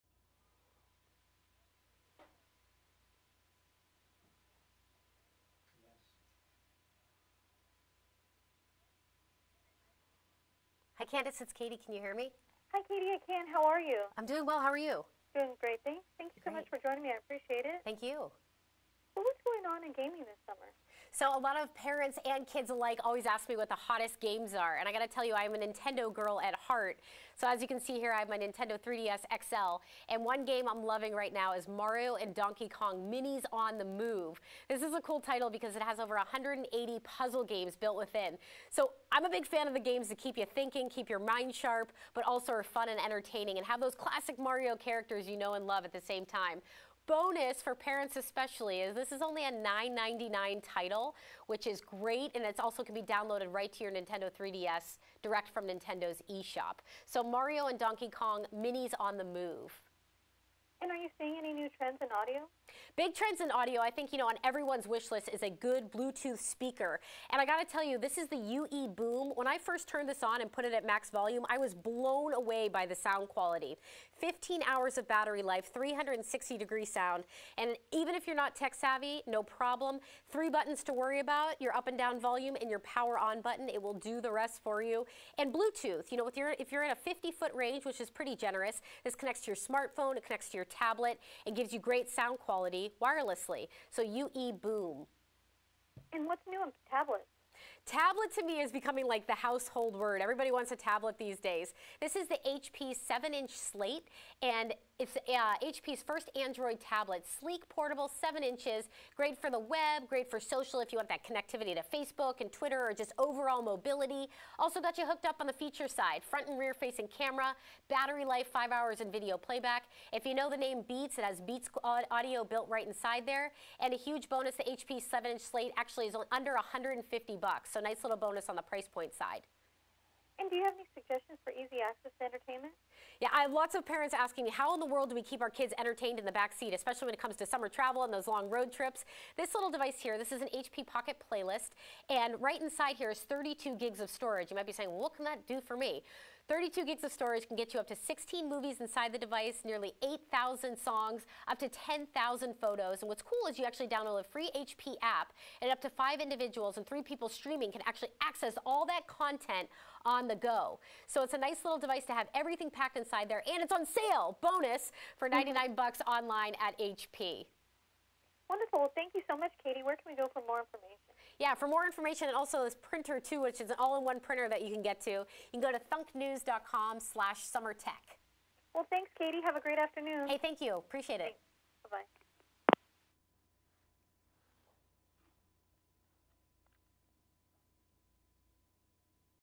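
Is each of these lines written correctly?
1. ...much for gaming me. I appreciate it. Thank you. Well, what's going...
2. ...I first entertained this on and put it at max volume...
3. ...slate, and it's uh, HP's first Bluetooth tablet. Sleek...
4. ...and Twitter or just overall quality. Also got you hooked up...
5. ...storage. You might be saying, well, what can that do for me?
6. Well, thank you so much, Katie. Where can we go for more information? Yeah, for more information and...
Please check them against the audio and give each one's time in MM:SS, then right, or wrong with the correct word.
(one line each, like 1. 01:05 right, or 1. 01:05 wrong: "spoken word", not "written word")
1. 00:16 wrong: "joining", not "gaming"
2. 01:09 wrong: "turned", not "entertained"
3. 01:43 wrong: "Android", not "Bluetooth"
4. 01:52 wrong: "mobility", not "quality"
5. 02:24 right
6. 02:48 right.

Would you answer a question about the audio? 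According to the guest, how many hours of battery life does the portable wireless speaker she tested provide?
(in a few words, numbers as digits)
15 hours.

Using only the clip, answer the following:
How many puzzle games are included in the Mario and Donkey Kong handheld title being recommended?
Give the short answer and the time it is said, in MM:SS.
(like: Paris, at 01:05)
over 180, at 00:35.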